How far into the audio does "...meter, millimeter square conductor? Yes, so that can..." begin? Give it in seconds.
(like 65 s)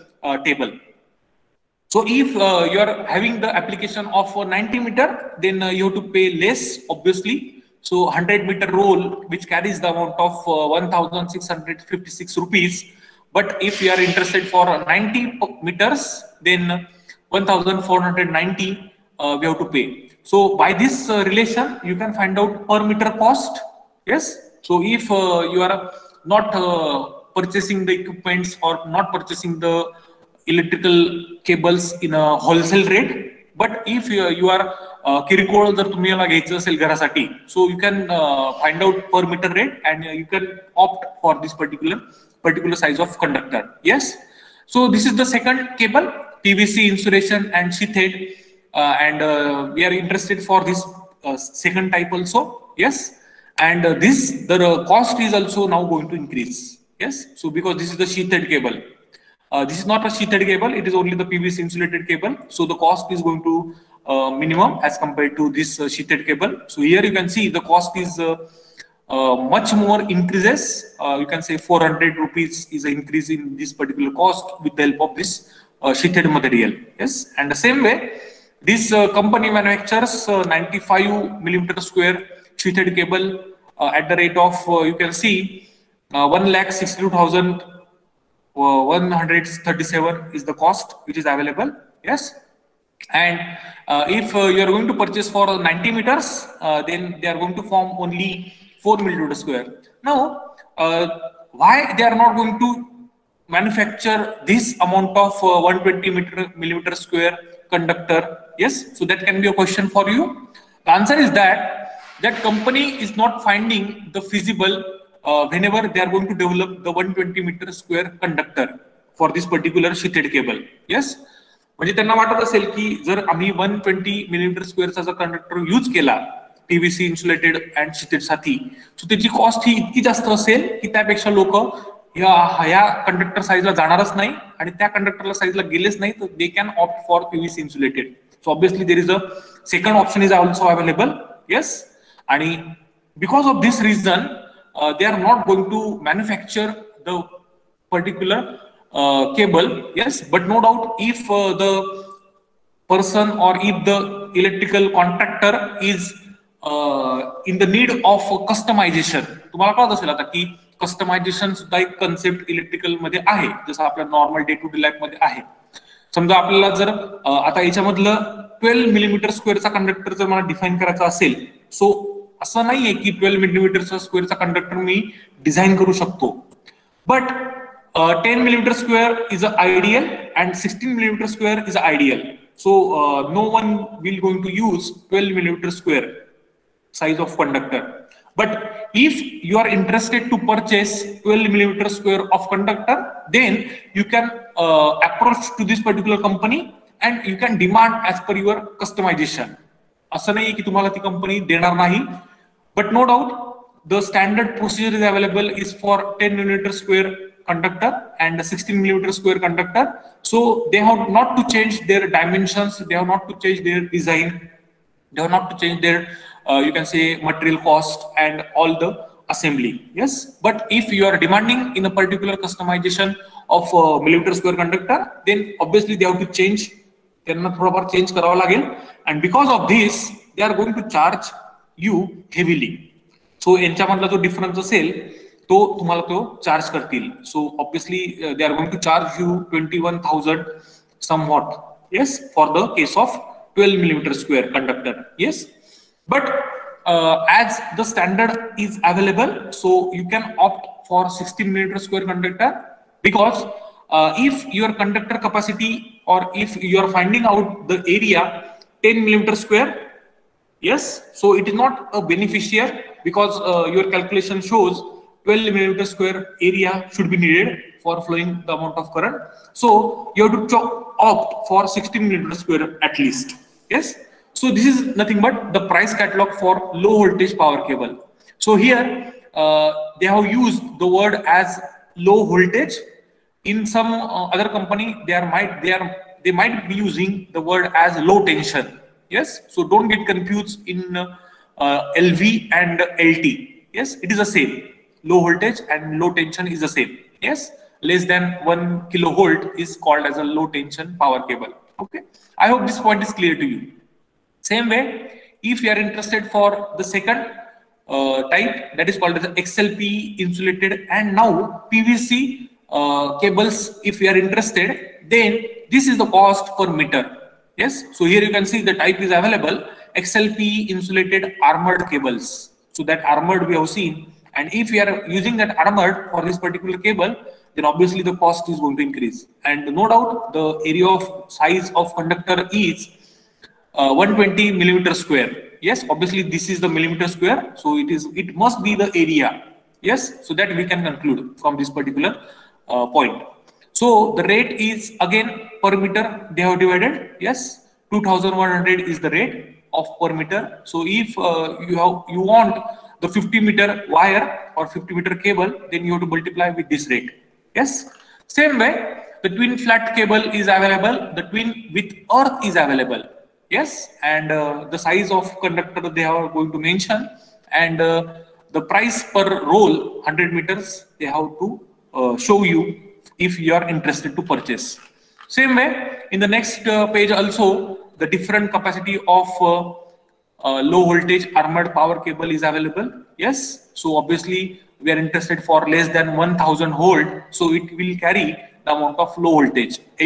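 106 s.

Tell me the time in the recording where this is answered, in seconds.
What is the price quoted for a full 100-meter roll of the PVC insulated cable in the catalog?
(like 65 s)
10 s.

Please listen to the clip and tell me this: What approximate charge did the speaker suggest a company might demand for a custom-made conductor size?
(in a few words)
21000.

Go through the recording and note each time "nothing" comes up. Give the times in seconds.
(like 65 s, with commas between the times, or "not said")
274 s.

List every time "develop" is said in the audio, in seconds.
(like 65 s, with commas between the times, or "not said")
116 s.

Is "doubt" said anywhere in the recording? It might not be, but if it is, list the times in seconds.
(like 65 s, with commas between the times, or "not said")
329 s.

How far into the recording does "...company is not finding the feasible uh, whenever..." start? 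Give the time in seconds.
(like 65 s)
112 s.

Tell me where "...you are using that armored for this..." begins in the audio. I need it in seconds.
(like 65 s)
324 s.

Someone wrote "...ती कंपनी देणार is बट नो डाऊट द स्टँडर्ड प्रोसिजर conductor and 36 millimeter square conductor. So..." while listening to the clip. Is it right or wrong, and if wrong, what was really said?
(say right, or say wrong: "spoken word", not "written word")
wrong: "16", not "36".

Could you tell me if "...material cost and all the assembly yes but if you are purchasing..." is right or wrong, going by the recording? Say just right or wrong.
wrong.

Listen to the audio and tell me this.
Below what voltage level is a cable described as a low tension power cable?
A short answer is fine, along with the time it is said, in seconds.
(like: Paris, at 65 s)
one kilovolt, at 298 s.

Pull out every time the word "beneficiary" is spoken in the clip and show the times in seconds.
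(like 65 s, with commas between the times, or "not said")
262 s.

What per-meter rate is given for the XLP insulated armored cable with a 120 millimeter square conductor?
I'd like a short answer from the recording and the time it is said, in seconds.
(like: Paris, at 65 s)
2100, at 347 s.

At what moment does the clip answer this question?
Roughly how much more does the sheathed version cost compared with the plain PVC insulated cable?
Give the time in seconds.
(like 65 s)
71 s.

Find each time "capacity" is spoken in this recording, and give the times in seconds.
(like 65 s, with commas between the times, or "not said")
255 s, 378 s.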